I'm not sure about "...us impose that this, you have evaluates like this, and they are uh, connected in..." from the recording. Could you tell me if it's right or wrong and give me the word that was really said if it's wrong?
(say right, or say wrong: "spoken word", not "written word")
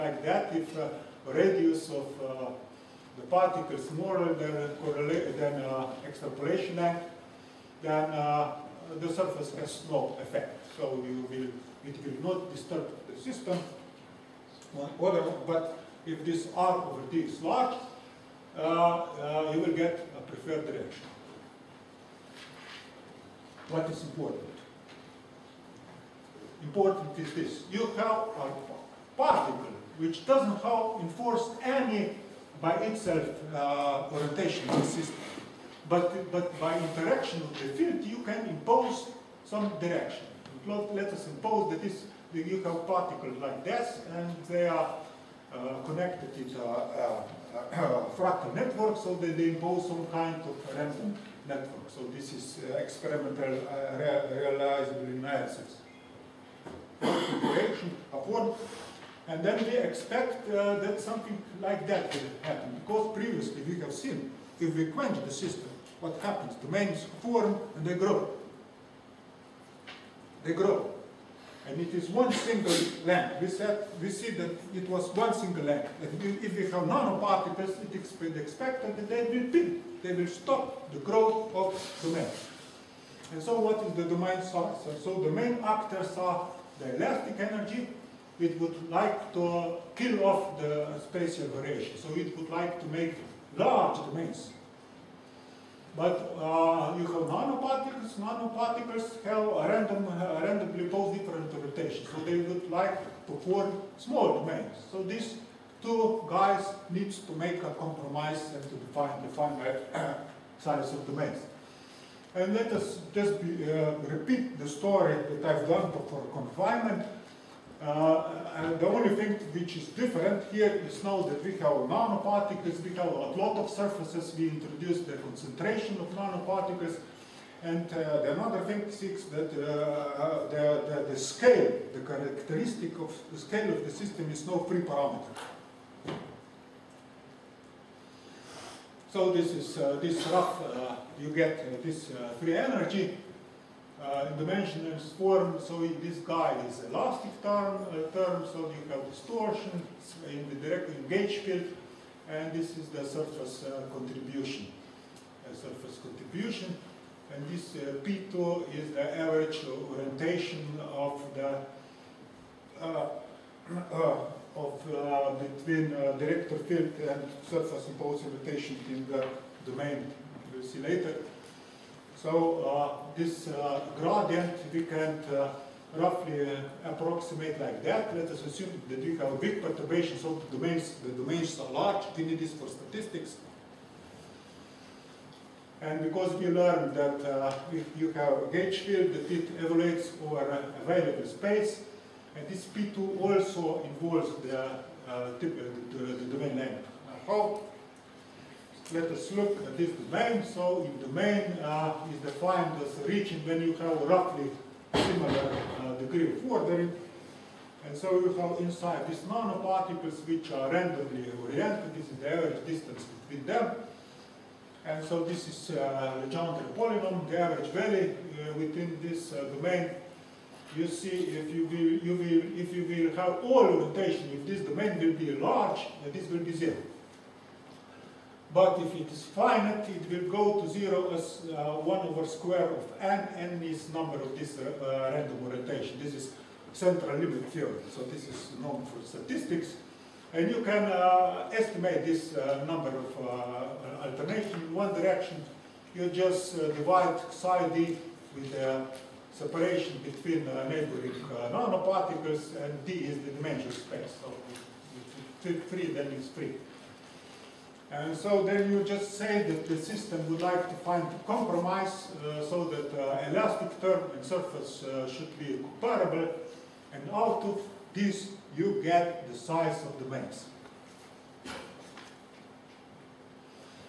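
wrong: "particles", not "evaluates".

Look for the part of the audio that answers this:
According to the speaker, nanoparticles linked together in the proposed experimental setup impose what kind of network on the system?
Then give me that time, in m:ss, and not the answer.
0:50.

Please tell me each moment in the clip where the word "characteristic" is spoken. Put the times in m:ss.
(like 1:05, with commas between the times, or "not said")
2:11.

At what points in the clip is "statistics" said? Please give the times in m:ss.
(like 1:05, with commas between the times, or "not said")
3:02, 3:59.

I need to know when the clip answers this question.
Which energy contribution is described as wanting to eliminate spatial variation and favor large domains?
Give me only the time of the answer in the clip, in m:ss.
1:26.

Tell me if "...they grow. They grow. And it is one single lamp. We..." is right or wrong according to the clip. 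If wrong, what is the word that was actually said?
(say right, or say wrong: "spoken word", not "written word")
right.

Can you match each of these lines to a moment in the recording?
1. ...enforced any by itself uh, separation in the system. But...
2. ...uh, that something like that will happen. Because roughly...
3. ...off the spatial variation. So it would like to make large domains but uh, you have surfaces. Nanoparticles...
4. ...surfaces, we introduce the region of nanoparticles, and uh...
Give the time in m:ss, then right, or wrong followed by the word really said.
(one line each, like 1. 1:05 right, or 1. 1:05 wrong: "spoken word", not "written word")
1. 0:30 wrong: "orientation", not "separation"
2. 1:00 wrong: "previously", not "roughly"
3. 1:30 wrong: "nanoparticles", not "surfaces"
4. 2:03 wrong: "concentration", not "region".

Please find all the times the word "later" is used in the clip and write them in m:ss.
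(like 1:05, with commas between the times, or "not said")
2:50.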